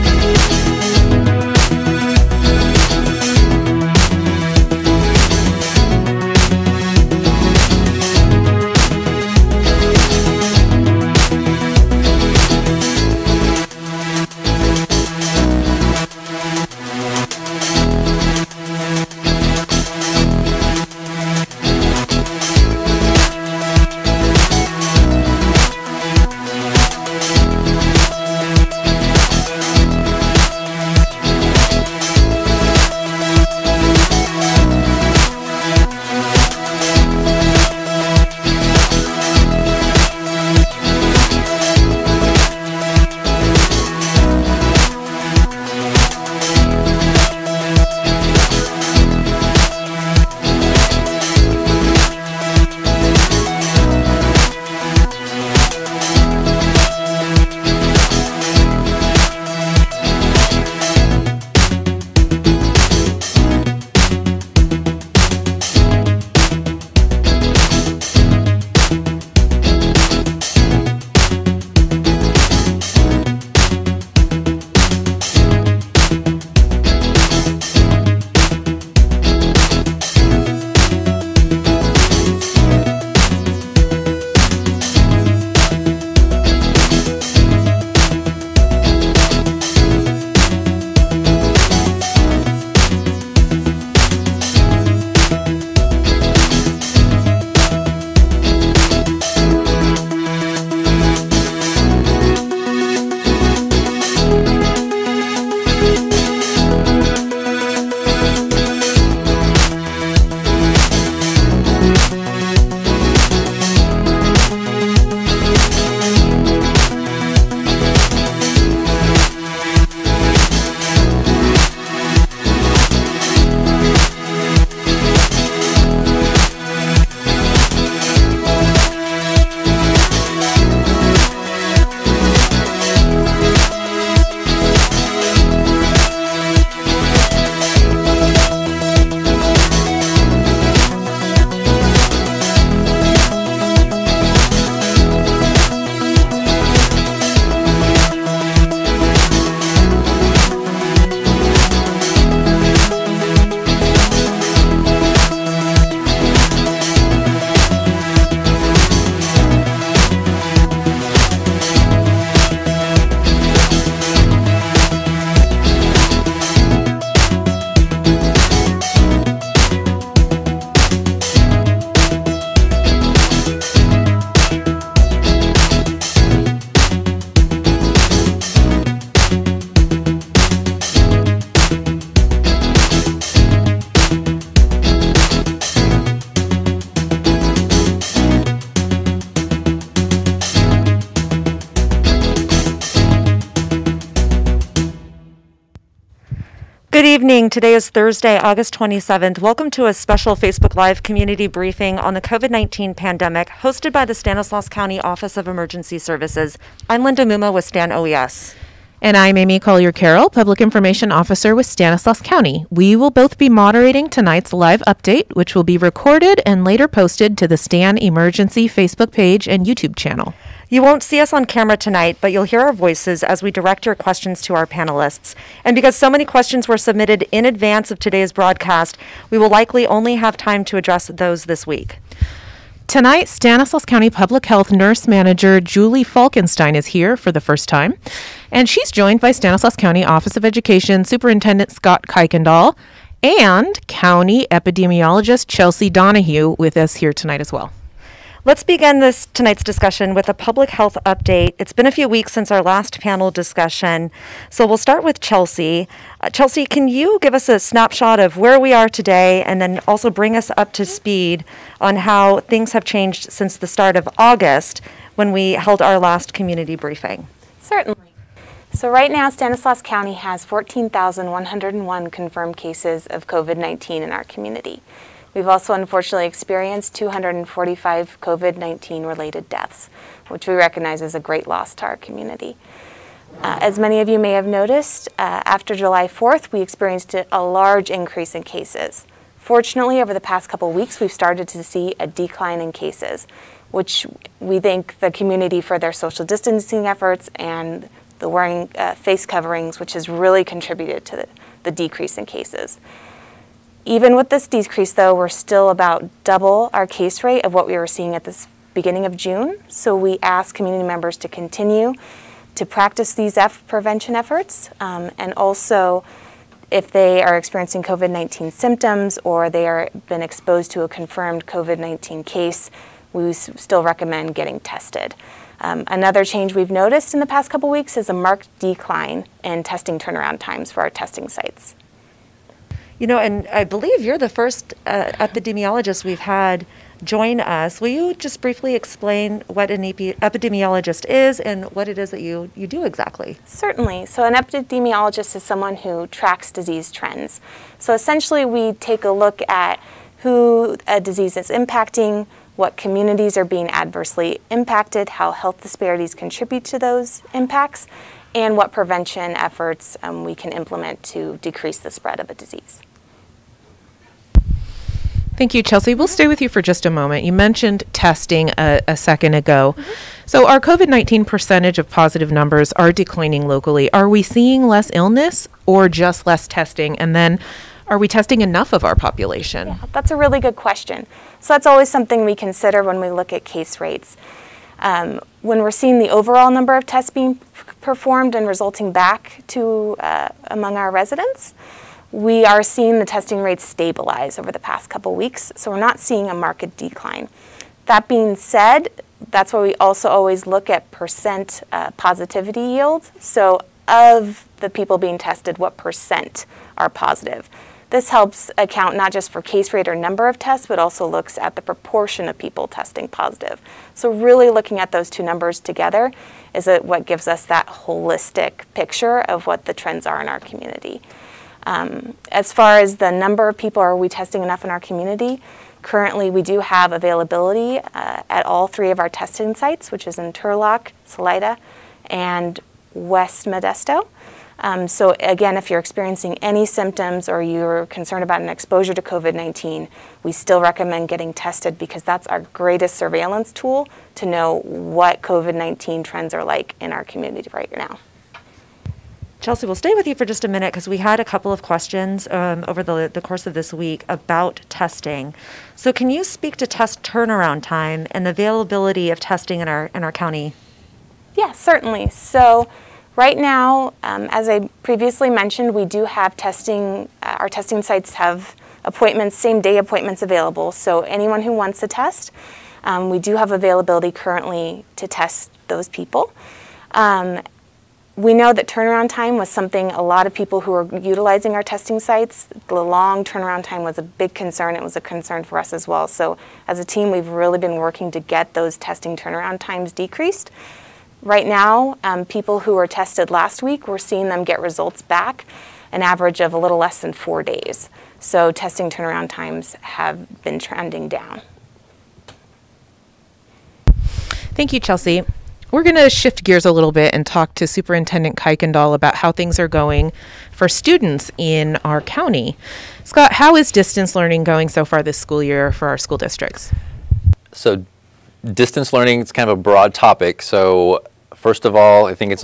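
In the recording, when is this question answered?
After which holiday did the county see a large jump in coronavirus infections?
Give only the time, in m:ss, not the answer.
4:45.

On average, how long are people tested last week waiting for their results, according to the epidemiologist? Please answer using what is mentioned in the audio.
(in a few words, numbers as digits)
a little less than four days.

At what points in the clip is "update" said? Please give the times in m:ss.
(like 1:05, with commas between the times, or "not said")
3:34, 4:11.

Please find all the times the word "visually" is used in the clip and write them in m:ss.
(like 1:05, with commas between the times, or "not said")
not said.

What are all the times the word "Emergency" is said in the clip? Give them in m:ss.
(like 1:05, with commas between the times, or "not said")
3:25, 3:37.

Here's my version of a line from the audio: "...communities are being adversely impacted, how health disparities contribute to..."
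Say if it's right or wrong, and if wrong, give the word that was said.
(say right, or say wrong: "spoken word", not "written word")
right.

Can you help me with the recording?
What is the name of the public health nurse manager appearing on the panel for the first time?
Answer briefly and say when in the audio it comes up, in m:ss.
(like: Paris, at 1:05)
Julie Falkenstein, at 3:55.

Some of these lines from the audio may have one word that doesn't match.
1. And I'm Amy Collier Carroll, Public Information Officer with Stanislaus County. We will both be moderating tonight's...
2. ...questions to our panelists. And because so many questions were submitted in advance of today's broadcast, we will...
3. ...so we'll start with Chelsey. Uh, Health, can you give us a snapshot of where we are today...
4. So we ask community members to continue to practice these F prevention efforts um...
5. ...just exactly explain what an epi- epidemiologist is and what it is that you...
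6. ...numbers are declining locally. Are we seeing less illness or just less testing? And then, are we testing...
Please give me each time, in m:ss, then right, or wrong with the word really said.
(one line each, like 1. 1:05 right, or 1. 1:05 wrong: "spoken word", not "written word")
1. 3:28 right
2. 3:43 right
3. 4:14 wrong: "Chelsey", not "Health"
4. 5:09 right
5. 5:38 wrong: "briefly", not "exactly"
6. 6:12 right.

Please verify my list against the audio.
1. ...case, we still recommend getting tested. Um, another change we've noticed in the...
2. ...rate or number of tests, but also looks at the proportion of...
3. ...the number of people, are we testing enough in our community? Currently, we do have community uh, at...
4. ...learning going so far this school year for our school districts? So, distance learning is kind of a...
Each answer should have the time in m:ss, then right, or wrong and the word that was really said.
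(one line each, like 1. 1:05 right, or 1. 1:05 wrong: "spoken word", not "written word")
1. 5:22 right
2. 6:49 right
3. 7:02 wrong: "availability", not "community"
4. 8:34 right.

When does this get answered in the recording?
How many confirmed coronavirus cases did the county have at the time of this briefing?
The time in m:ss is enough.
4:30.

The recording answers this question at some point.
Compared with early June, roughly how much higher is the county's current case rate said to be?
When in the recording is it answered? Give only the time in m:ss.
5:06.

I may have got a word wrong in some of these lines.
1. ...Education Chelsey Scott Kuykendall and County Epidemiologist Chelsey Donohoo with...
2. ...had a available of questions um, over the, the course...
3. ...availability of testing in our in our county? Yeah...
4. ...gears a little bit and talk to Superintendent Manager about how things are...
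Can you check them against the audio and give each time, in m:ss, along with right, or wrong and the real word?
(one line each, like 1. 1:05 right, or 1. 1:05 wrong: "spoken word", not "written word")
1. 4:00 wrong: "Superintendent", not "Chelsey"
2. 7:30 wrong: "couple", not "available"
3. 7:38 right
4. 8:26 wrong: "Kuykendall", not "Manager".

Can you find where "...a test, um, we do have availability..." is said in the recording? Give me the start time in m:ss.
7:51.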